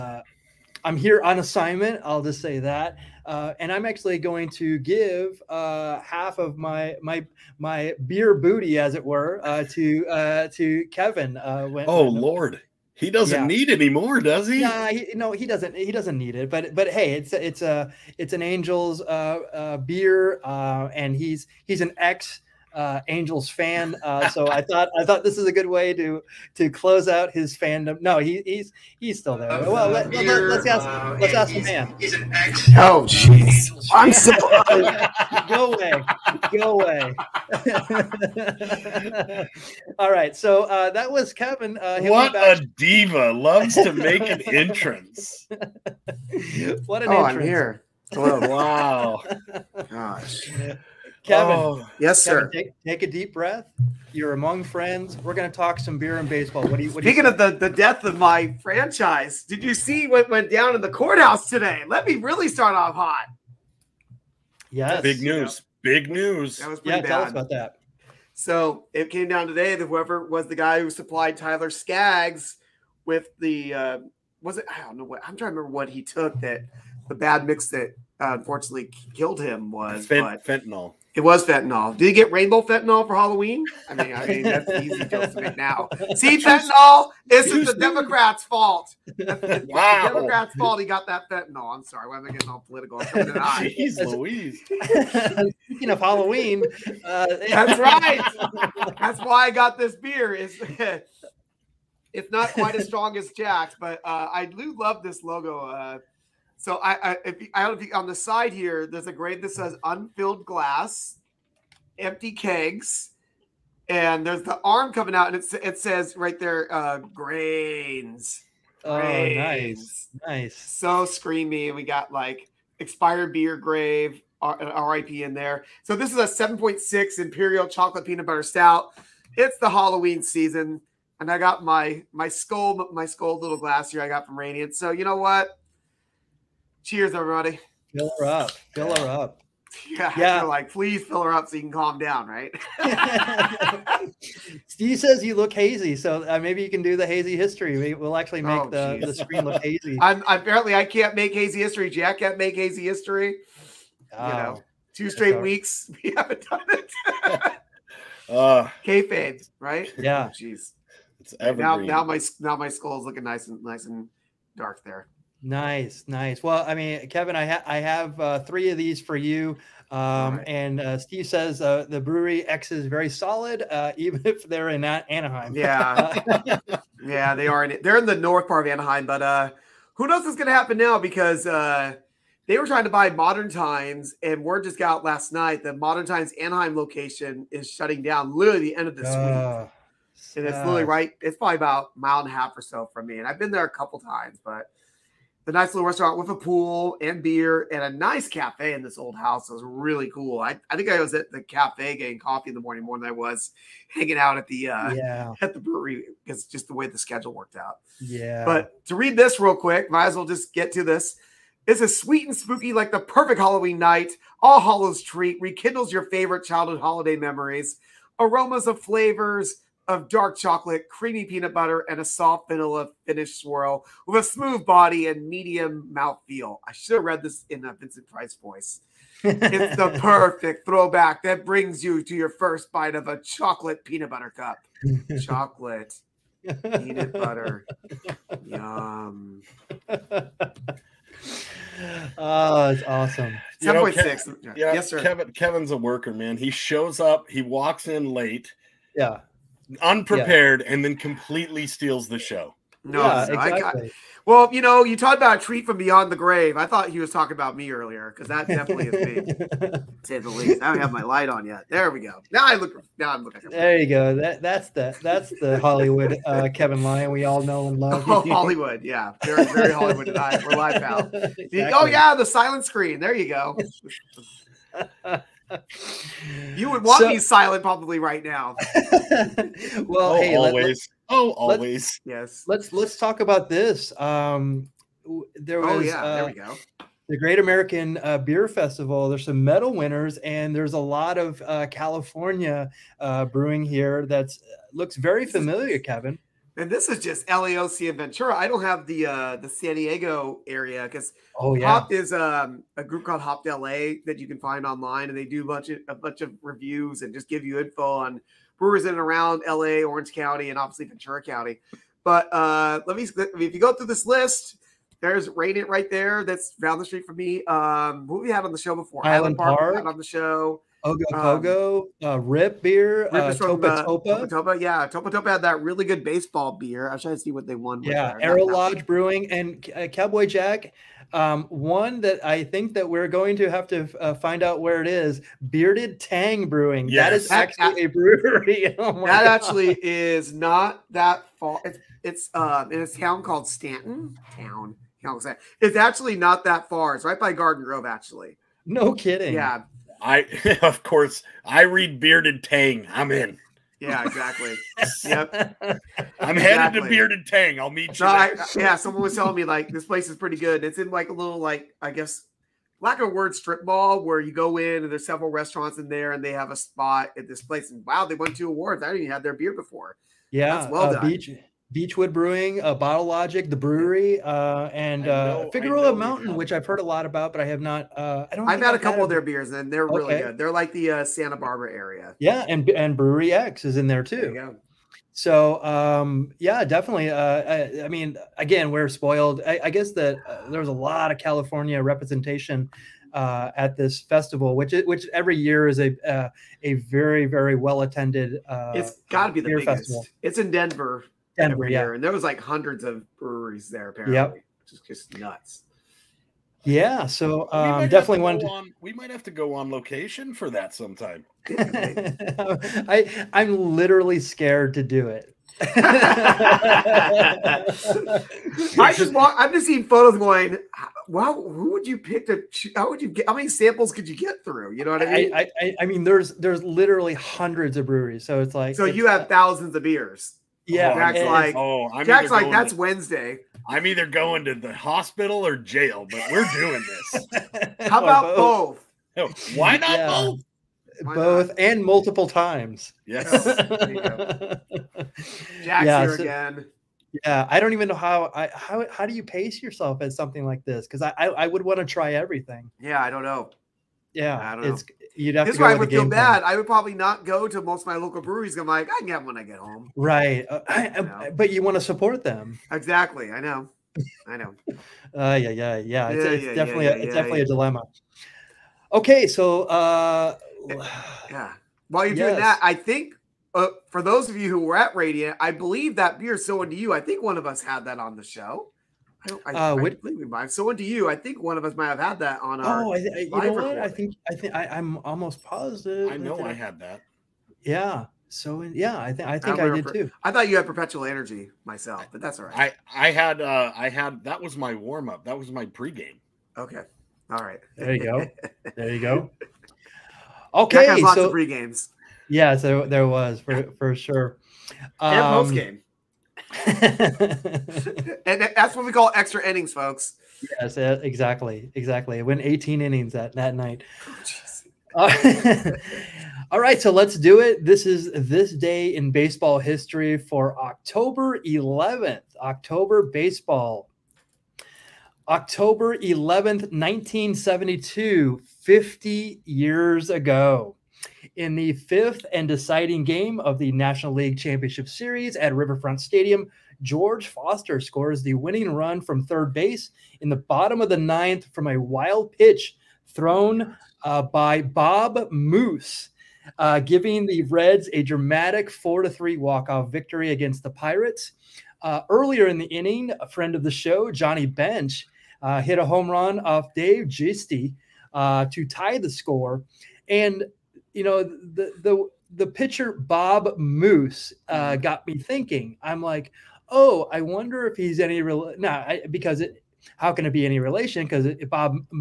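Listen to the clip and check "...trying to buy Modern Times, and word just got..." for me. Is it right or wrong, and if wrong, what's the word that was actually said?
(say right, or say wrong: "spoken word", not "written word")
right.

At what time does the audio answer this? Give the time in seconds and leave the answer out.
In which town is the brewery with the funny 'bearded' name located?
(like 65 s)
343 s.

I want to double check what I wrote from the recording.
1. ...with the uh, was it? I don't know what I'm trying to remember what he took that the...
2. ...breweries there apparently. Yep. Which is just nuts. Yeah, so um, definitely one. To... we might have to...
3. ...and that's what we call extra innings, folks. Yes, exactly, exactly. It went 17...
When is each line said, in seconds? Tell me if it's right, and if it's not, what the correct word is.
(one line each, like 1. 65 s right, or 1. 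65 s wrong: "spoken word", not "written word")
1. 73 s right
2. 403 s right
3. 506 s wrong: "18", not "17".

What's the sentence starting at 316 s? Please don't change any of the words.
That's down the street from me.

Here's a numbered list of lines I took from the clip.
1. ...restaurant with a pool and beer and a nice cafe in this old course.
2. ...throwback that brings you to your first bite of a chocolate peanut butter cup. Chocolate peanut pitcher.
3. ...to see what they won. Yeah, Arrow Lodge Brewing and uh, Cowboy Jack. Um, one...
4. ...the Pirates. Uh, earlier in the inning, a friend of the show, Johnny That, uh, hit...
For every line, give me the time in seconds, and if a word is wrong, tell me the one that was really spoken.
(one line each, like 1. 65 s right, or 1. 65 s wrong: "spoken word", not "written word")
1. 195 s wrong: "house", not "course"
2. 230 s wrong: "butter", not "pitcher"
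3. 327 s right
4. 550 s wrong: "Bench", not "That".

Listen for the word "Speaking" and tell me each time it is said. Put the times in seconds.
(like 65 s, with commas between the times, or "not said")
57 s, 95 s.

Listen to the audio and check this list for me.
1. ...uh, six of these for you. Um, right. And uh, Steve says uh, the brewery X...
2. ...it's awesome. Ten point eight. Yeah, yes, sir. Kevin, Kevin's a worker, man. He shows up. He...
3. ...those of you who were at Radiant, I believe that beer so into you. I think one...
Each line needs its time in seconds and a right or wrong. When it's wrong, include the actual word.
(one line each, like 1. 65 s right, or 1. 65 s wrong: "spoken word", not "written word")
1. 168 s wrong: "three", not "six"
2. 242 s wrong: "six", not "eight"
3. 474 s right.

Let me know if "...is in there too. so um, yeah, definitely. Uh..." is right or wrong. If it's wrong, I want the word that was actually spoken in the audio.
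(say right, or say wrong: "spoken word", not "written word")
right.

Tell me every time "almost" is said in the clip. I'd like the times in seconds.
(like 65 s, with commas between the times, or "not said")
485 s.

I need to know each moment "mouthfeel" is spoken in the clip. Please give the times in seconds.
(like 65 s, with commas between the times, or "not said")
225 s.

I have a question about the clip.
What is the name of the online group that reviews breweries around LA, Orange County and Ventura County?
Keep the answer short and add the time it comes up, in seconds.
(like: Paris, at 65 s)
Hopped LA, at 303 s.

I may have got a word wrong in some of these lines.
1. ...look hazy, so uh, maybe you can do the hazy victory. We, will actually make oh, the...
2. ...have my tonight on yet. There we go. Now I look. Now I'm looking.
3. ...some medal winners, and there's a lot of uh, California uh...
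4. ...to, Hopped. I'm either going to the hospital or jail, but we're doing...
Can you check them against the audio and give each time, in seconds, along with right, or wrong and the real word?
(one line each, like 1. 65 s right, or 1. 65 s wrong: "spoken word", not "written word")
1. 145 s wrong: "history", not "victory"
2. 260 s wrong: "light", not "tonight"
3. 289 s right
4. 432 s wrong: "Wednesday", not "Hopped".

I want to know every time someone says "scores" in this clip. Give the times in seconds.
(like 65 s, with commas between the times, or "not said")
537 s, 559 s.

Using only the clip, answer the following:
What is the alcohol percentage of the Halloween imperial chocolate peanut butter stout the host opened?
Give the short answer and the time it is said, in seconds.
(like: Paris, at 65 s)
7.6, at 126 s.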